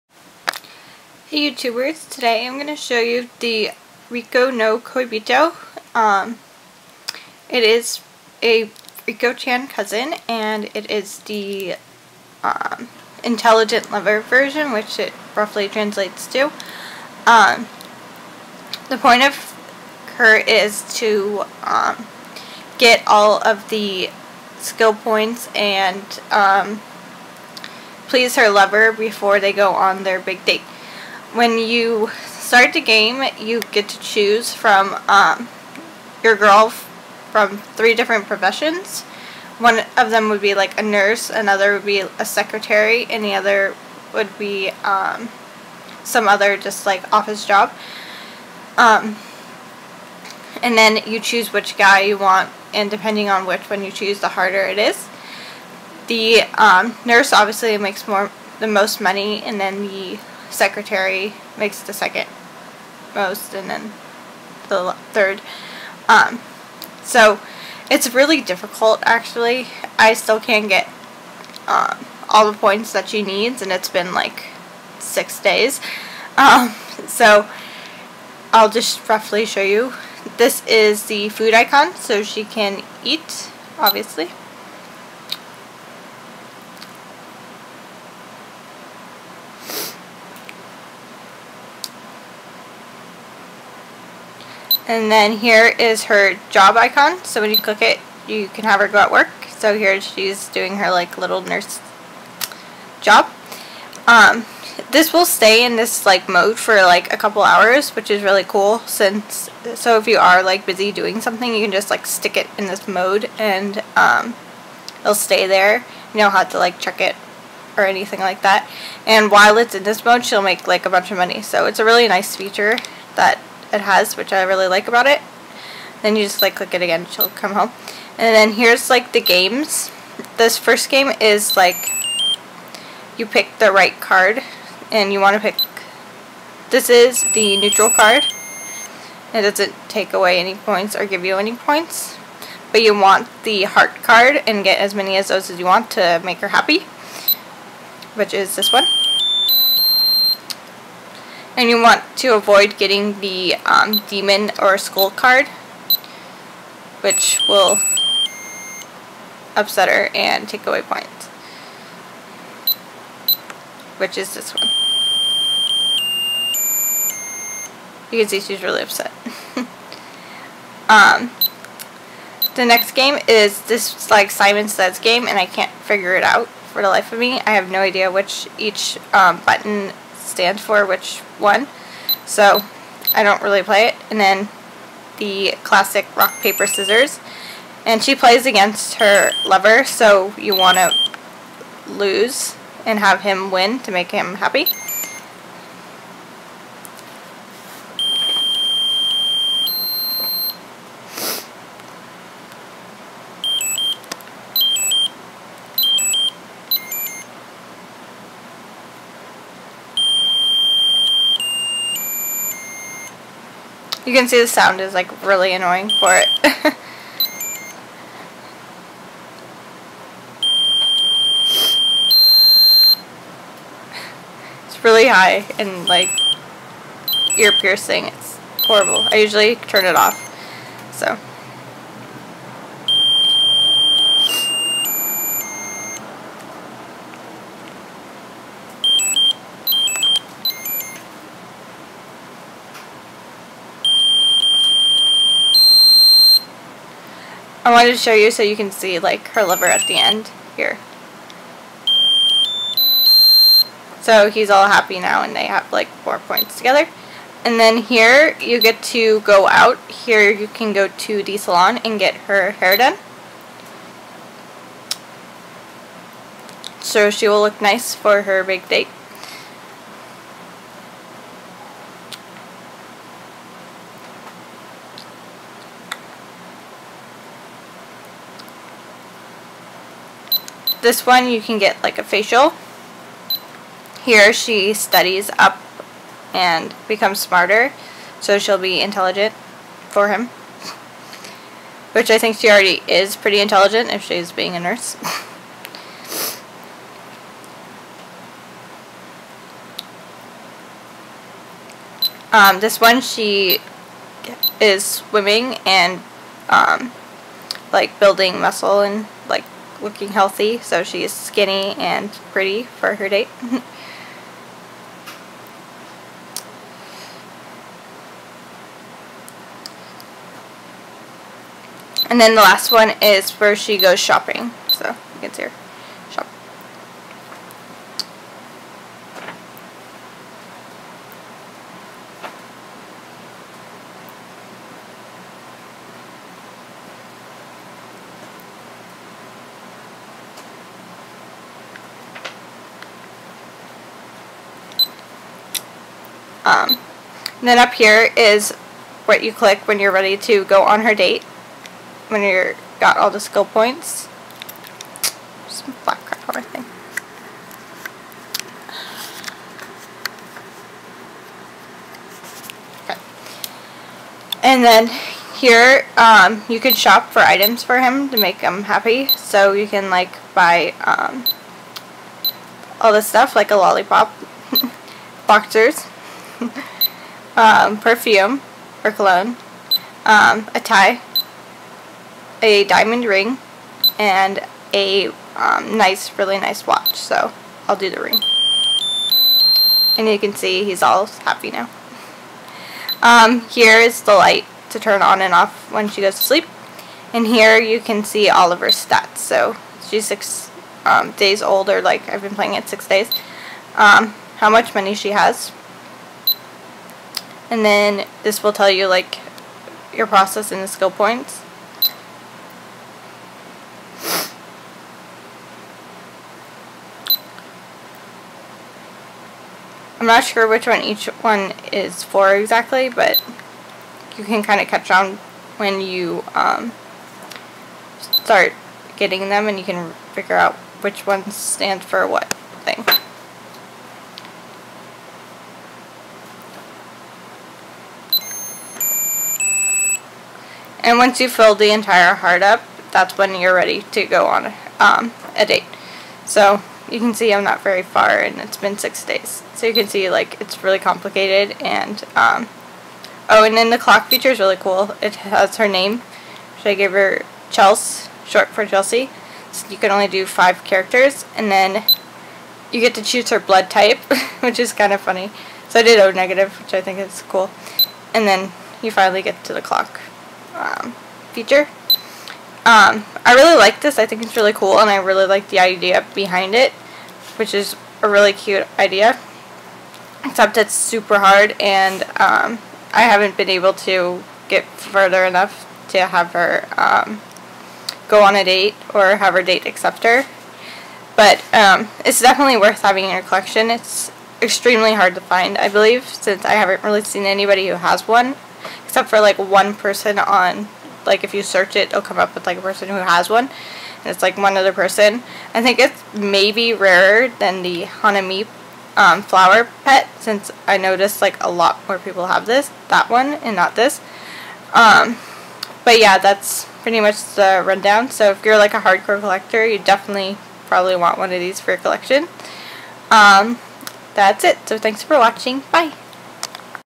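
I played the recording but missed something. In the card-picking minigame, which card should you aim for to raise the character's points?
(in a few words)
Heart card.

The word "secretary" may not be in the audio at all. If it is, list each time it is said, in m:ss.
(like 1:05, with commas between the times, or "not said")
0:42, 1:00.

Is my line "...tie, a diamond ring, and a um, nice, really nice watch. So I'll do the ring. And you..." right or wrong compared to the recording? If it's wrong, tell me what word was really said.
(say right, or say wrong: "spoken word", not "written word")
right.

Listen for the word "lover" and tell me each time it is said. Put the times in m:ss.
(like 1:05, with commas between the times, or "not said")
0:13, 0:28, 3:09.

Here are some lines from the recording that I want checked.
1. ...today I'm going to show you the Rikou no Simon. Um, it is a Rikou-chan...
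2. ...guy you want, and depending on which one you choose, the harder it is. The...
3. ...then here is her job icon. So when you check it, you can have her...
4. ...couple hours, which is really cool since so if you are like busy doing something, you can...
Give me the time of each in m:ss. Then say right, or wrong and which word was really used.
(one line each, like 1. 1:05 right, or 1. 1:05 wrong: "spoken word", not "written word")
1. 0:02 wrong: "Koibito", not "Simon"
2. 0:51 right
3. 1:35 wrong: "click", not "check"
4. 1:47 right.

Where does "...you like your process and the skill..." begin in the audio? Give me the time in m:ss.
6:48.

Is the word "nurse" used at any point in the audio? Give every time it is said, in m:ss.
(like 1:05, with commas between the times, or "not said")
0:40, 0:57, 1:41, 4:54.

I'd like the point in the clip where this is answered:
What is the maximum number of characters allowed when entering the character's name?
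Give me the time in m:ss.
7:40.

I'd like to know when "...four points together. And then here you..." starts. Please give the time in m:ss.
4:16.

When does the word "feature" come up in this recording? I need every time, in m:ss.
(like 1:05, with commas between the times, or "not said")
2:02, 7:34, 7:51.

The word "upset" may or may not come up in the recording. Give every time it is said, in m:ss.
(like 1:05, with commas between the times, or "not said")
2:39, 2:48.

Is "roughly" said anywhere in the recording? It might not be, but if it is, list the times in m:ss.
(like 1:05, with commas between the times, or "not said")
0:15, 1:19.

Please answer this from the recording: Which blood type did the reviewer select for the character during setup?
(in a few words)
O negative.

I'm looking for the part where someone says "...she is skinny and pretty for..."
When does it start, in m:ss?
5:10.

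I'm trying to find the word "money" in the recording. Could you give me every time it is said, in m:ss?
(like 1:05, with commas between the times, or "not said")
0:58, 2:01, 6:44.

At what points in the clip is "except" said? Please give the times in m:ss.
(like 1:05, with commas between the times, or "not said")
8:00, 8:18.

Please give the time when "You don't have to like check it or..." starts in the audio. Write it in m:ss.
1:56.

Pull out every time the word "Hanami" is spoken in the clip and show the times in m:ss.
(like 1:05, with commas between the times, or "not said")
8:27.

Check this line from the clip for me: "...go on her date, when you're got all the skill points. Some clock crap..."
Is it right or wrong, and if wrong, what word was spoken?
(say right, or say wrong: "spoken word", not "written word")
wrong: "black", not "clock".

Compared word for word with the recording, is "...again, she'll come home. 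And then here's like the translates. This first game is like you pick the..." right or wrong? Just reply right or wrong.
wrong.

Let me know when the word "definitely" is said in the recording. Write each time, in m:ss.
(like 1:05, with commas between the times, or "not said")
8:12, 8:39.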